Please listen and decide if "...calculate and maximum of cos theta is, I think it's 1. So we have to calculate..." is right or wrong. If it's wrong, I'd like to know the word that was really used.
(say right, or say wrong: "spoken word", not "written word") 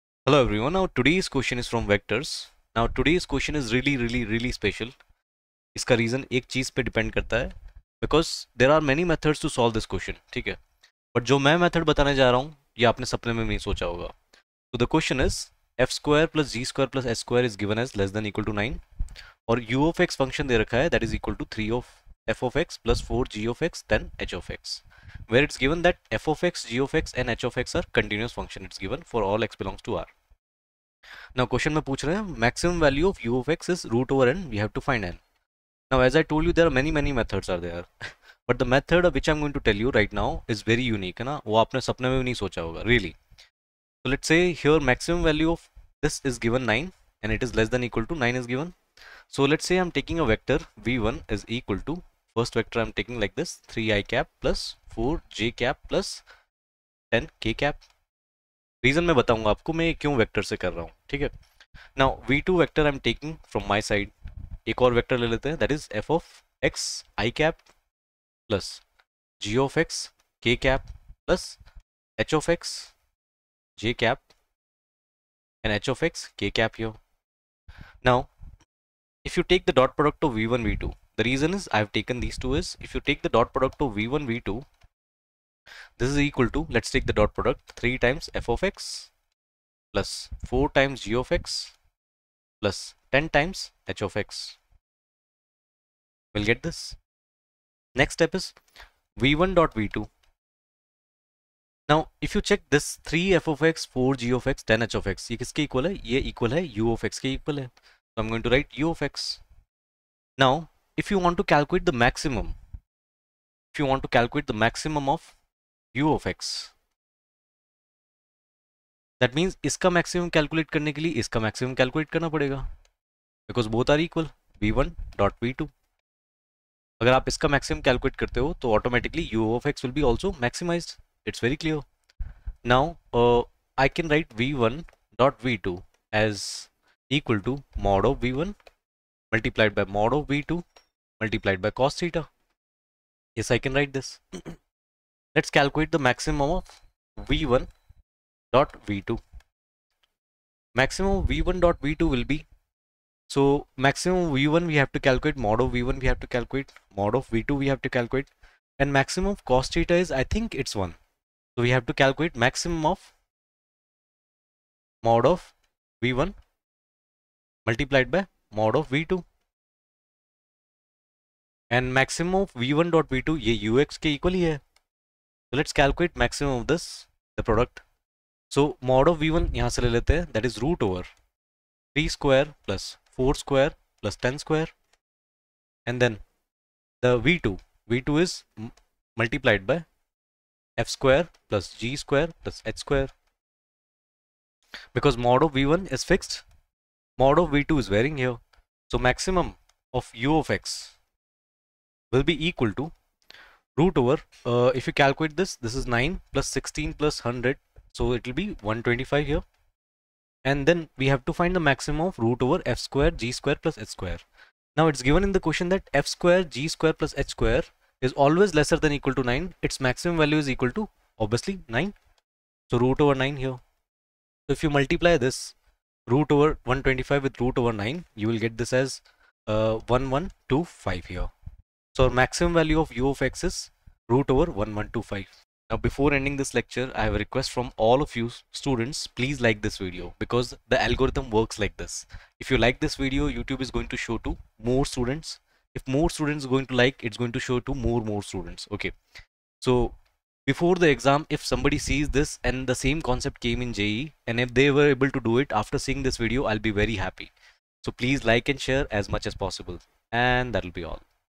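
right.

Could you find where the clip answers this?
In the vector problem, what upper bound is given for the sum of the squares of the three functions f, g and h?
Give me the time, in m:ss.
0:17.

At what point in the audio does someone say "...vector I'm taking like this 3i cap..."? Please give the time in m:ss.
0:52.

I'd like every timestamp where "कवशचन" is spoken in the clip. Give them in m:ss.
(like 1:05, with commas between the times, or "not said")
0:09, 0:14.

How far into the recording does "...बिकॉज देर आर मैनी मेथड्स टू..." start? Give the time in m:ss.
0:08.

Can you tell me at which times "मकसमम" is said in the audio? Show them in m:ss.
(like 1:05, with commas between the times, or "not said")
2:51, 2:56.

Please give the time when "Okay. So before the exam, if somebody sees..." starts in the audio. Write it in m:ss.
4:08.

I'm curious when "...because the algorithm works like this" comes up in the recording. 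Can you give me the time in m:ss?
4:00.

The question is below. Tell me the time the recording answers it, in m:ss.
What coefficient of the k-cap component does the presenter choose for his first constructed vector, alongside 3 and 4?
0:57.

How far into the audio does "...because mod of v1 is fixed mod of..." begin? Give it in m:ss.
3:14.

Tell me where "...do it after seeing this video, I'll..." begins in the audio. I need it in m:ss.
4:15.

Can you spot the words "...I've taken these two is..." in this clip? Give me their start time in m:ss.
1:21.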